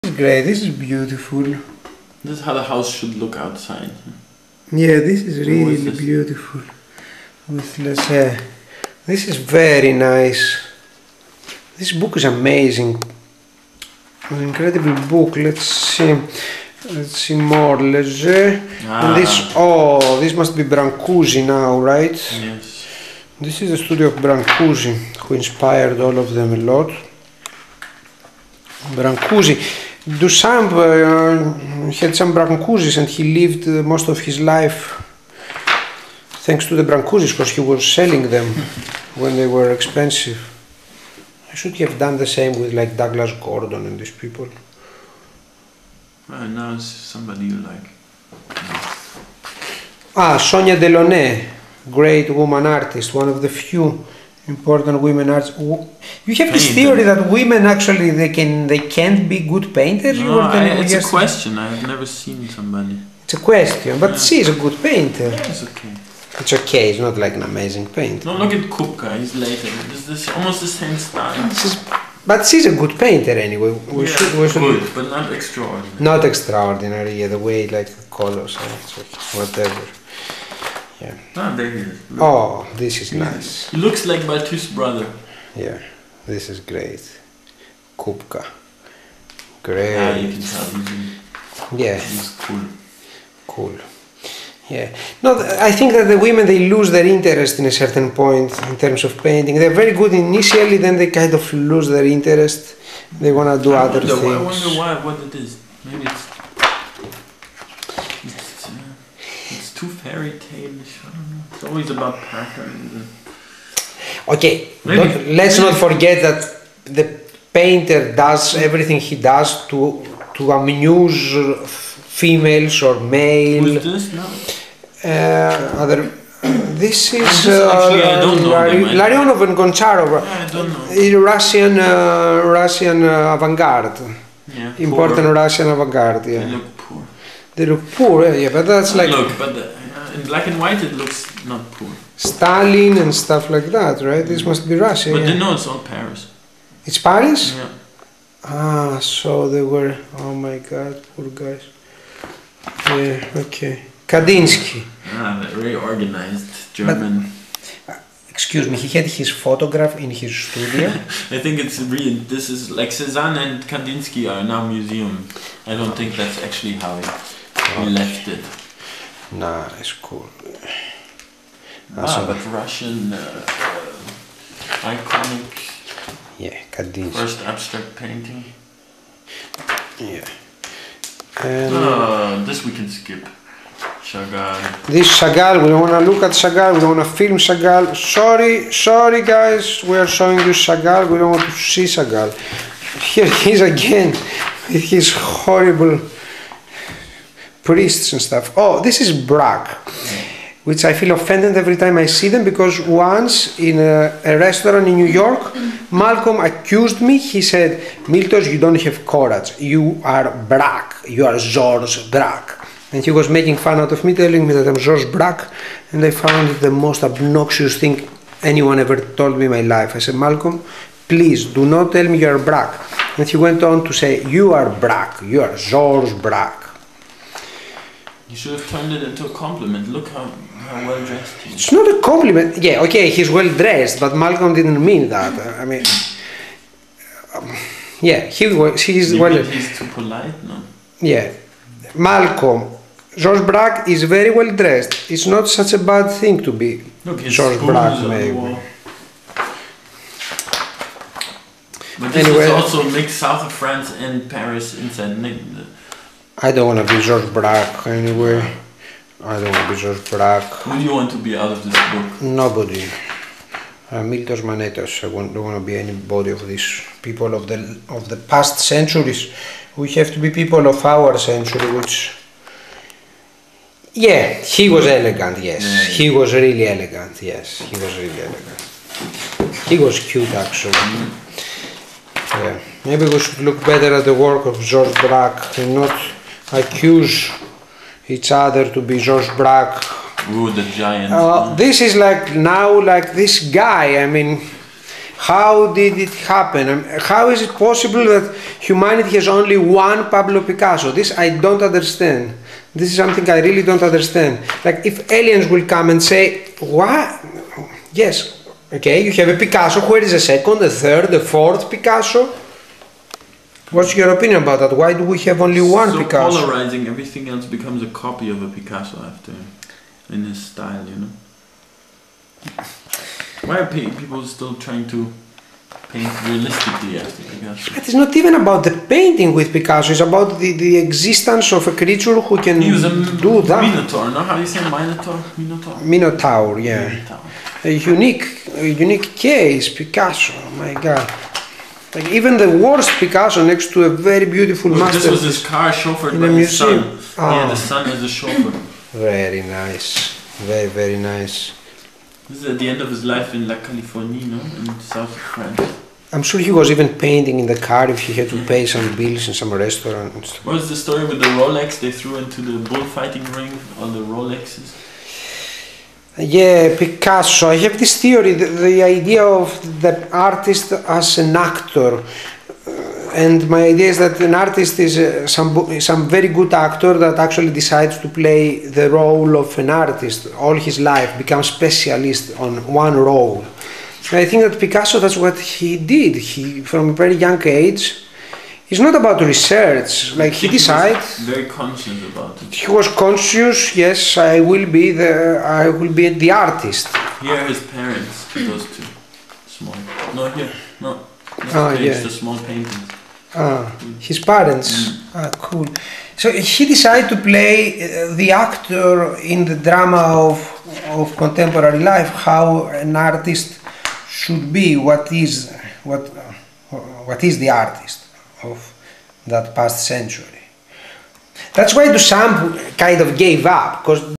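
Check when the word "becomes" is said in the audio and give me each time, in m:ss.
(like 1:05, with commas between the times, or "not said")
5:17, 6:21.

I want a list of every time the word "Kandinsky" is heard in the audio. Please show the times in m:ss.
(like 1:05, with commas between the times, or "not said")
2:34, 2:43.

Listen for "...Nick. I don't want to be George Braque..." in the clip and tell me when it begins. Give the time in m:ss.
4:15.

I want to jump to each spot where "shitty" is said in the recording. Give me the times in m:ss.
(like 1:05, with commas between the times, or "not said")
not said.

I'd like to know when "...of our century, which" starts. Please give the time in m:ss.
4:30.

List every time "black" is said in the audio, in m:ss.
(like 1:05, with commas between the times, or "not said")
2:20.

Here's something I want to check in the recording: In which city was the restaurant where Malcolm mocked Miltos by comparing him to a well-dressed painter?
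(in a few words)
New York.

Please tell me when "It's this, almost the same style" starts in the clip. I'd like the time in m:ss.
1:09.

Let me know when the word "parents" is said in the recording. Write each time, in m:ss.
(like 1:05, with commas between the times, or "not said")
6:37, 6:44.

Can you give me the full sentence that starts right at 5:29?
It's about the, the existence of a creature who can he was a do that.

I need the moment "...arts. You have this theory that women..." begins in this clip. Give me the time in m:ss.
0:55.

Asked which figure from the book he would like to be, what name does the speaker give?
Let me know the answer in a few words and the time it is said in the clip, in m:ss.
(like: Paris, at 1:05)
Miltos Manetas, at 4:24.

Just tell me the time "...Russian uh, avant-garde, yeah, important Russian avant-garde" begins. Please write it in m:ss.
2:12.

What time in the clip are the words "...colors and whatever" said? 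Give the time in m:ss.
1:18.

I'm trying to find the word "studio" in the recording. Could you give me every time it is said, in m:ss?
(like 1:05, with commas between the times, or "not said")
0:23, 2:40.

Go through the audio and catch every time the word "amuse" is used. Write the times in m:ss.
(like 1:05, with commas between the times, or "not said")
2:00.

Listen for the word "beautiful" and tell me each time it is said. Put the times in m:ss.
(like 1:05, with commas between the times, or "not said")
0:00, 0:05, 5:44.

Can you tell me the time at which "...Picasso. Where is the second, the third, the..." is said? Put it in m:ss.
5:09.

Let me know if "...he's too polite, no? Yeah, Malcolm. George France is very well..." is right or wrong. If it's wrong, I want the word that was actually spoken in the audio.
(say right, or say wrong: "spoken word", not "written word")
wrong: "Braque", not "France".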